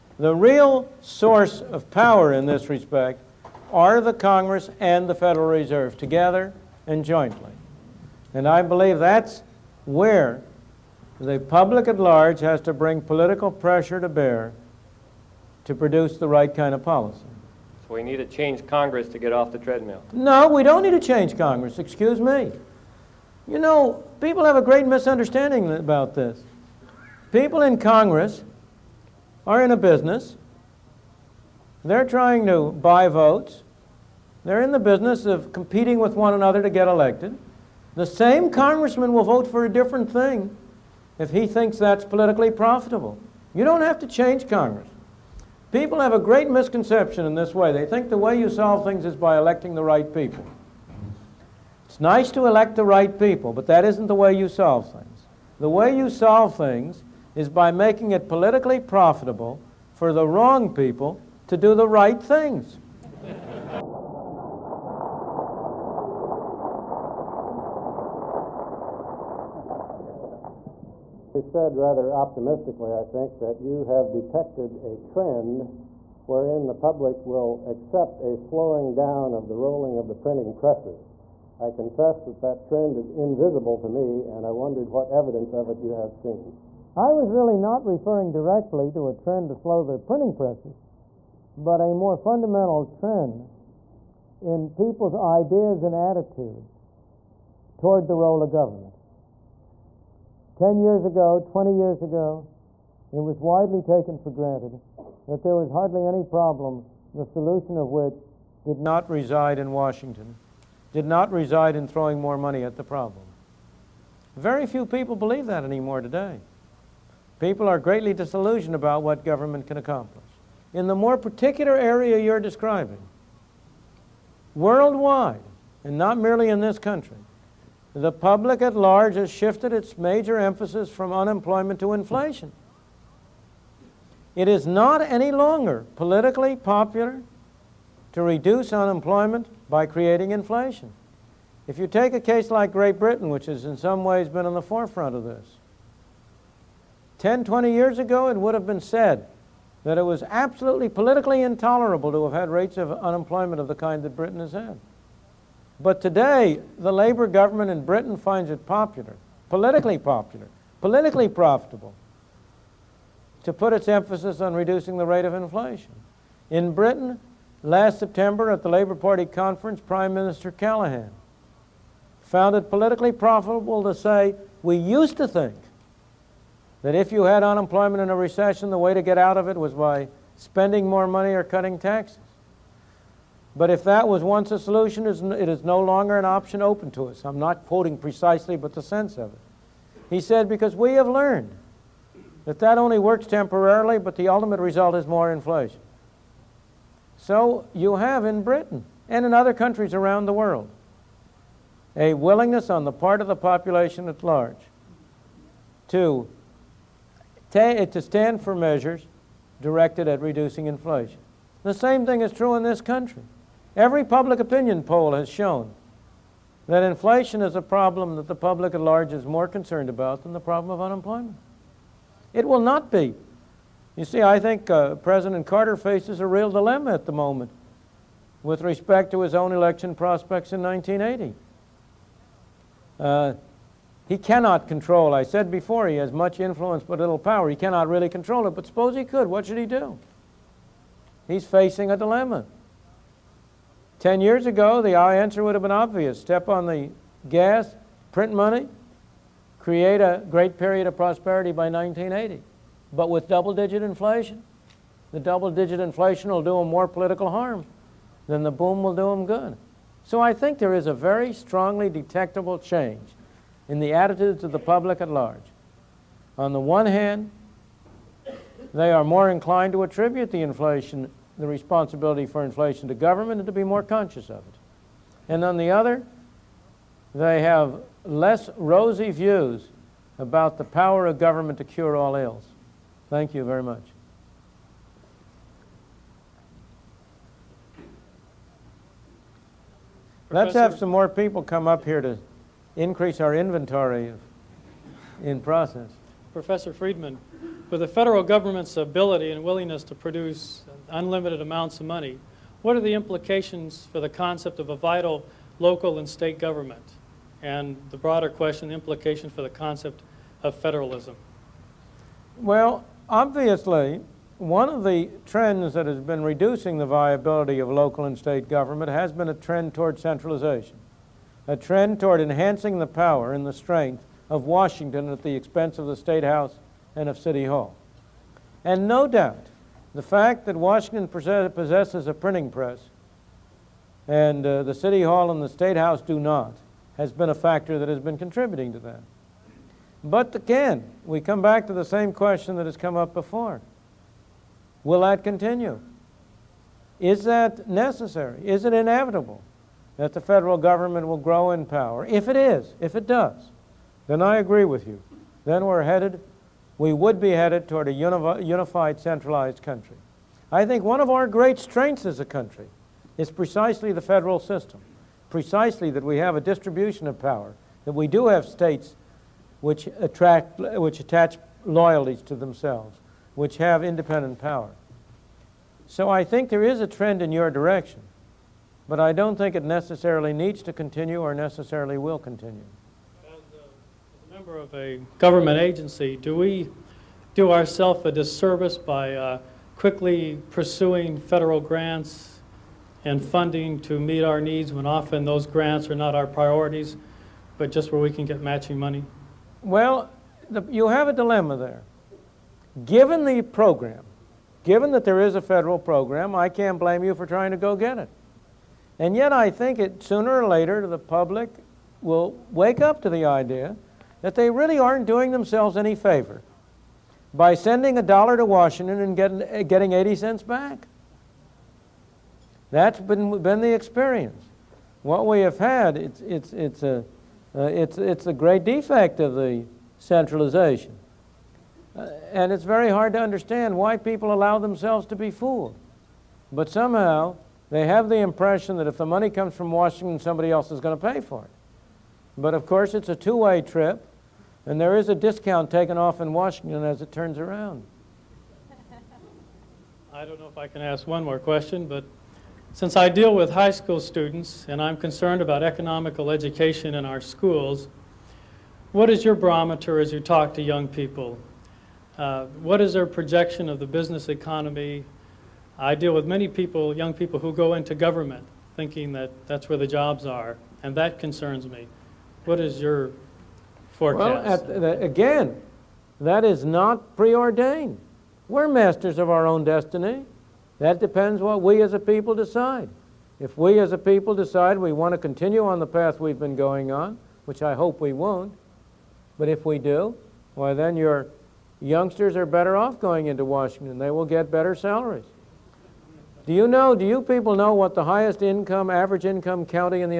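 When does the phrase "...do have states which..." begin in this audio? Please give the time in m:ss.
6:08.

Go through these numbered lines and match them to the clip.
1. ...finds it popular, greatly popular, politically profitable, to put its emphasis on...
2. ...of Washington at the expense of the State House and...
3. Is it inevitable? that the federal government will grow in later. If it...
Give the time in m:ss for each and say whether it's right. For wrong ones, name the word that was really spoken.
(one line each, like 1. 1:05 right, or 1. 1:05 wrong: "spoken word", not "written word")
1. 2:38 wrong: "politically", not "greatly"
2. 5:24 right
3. 5:48 wrong: "power", not "later".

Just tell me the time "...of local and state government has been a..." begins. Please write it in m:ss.
5:17.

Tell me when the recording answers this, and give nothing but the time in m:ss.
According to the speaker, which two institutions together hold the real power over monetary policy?
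0:03.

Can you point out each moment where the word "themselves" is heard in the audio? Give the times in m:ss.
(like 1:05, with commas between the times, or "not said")
6:12, 6:55, 7:14.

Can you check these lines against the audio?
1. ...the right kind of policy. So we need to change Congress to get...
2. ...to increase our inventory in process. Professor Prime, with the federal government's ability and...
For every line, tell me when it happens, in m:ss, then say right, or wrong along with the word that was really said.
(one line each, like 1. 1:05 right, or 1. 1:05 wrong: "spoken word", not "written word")
1. 0:16 right
2. 4:52 wrong: "Friedman", not "Prime".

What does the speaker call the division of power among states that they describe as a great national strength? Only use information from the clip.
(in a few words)
the federal system.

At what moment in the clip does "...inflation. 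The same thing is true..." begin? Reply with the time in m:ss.
3:30.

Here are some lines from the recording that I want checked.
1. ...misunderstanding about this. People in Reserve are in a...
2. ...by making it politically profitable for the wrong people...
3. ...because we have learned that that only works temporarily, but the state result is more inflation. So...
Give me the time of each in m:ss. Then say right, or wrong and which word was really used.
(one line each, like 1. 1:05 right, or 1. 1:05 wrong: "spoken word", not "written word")
1. 0:24 wrong: "Congress", not "Reserve"
2. 0:57 right
3. 3:10 wrong: "ultimate", not "state".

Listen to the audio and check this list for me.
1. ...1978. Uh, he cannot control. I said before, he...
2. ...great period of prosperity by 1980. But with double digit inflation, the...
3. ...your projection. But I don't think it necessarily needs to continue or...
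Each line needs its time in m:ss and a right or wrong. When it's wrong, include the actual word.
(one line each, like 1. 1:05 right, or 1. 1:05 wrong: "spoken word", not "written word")
1. 3:50 wrong: "1980", not "1978"
2. 4:10 right
3. 6:17 wrong: "direction", not "projection".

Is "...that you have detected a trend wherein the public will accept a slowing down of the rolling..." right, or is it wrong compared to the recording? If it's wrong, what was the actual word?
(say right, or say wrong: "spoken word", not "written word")
right.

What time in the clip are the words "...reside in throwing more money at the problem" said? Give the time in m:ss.
1:51.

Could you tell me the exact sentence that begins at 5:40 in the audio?
But again, we come back to the same question that has come up before.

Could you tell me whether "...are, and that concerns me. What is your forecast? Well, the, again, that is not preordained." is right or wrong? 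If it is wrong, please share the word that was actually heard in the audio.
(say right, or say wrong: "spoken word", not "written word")
right.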